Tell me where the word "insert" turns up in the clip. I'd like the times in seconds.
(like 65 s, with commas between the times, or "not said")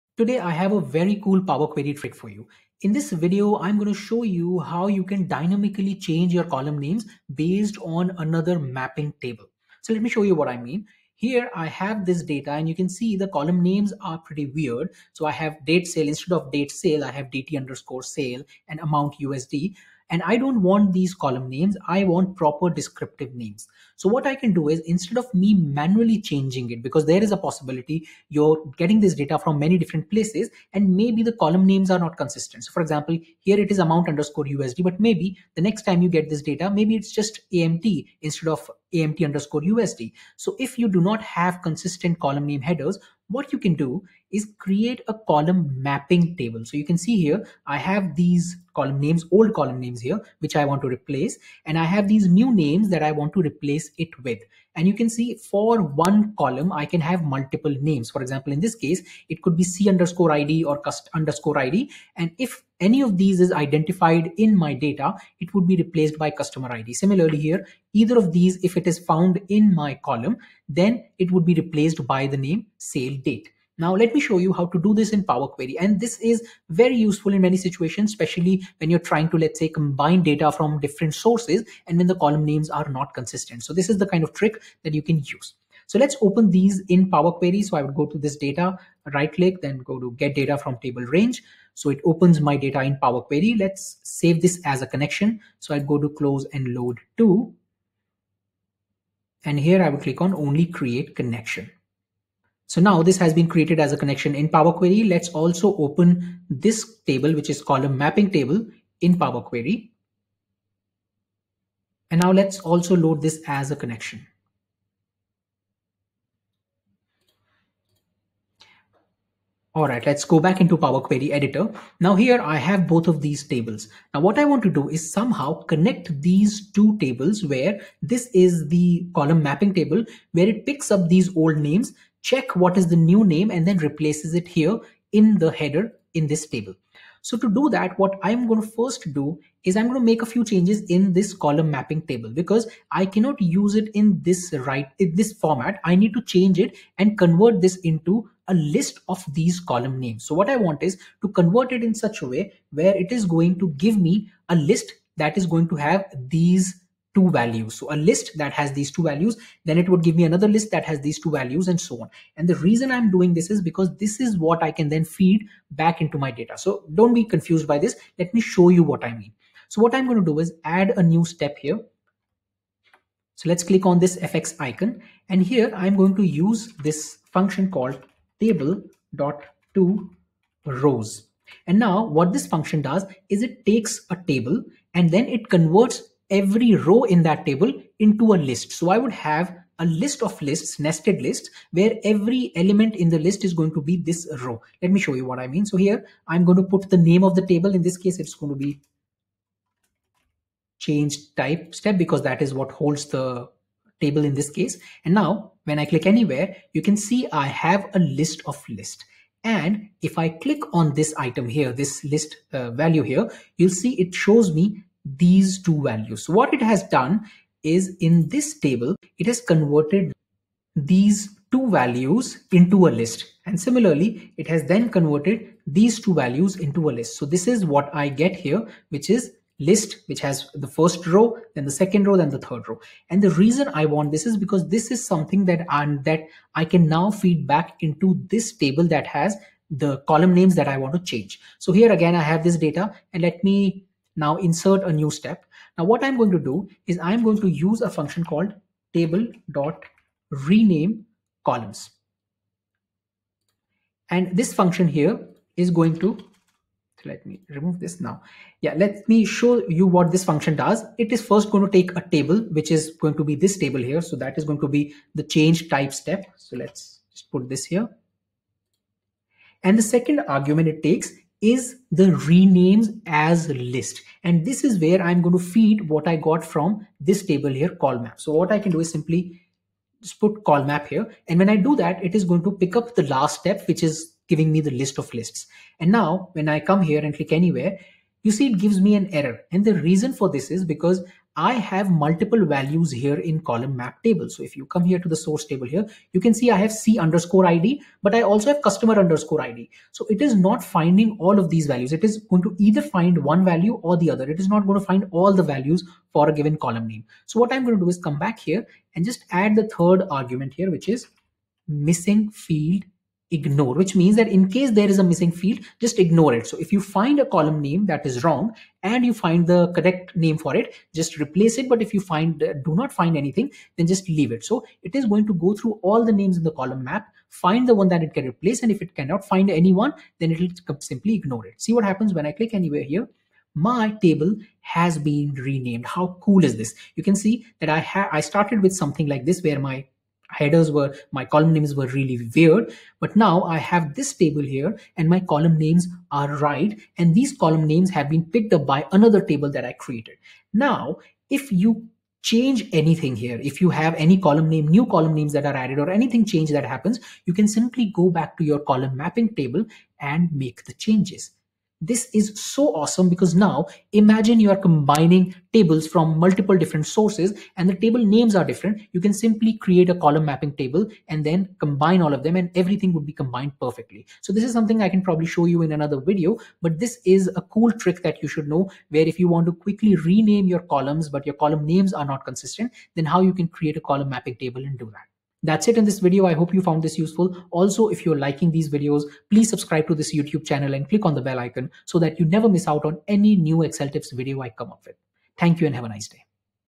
244 s.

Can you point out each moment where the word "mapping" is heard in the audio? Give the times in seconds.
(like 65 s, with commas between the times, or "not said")
8 s, 45 s, 107 s, 129 s, 141 s, 359 s, 370 s, 384 s.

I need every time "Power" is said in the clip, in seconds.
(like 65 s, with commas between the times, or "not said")
1 s, 75 s, 87 s, 92 s, 104 s, 109 s, 120 s.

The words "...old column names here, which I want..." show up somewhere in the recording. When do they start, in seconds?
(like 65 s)
49 s.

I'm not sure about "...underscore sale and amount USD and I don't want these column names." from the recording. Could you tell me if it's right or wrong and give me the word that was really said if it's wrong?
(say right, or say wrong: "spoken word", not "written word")
right.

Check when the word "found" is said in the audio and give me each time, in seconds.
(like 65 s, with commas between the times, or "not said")
68 s, 386 s.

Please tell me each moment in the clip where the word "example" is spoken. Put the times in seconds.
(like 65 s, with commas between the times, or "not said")
32 s, 58 s.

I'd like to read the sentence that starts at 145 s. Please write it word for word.
I need to change it and convert this into a list of these column names.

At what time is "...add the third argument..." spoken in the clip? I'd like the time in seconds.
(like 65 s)
309 s.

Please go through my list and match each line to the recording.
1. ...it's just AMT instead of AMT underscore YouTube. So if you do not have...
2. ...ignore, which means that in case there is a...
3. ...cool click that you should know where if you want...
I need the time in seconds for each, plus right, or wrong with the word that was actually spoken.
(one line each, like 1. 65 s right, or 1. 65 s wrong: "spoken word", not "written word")
1. 36 s wrong: "USD", not "YouTube"
2. 313 s right
3. 377 s wrong: "trick", not "click".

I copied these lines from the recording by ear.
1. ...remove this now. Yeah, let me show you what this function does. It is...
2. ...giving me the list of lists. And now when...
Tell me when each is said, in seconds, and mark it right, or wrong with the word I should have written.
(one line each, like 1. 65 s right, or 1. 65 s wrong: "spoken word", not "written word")
1. 257 s right
2. 284 s right.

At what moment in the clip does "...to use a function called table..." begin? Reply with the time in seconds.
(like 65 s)
247 s.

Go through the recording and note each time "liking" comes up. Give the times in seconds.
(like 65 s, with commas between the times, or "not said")
388 s.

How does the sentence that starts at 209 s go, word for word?
And if I click on this item here, this list uh, value here, you'll see it shows me these two values.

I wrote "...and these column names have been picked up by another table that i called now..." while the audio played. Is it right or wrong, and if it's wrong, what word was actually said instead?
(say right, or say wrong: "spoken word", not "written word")
wrong: "created", not "called".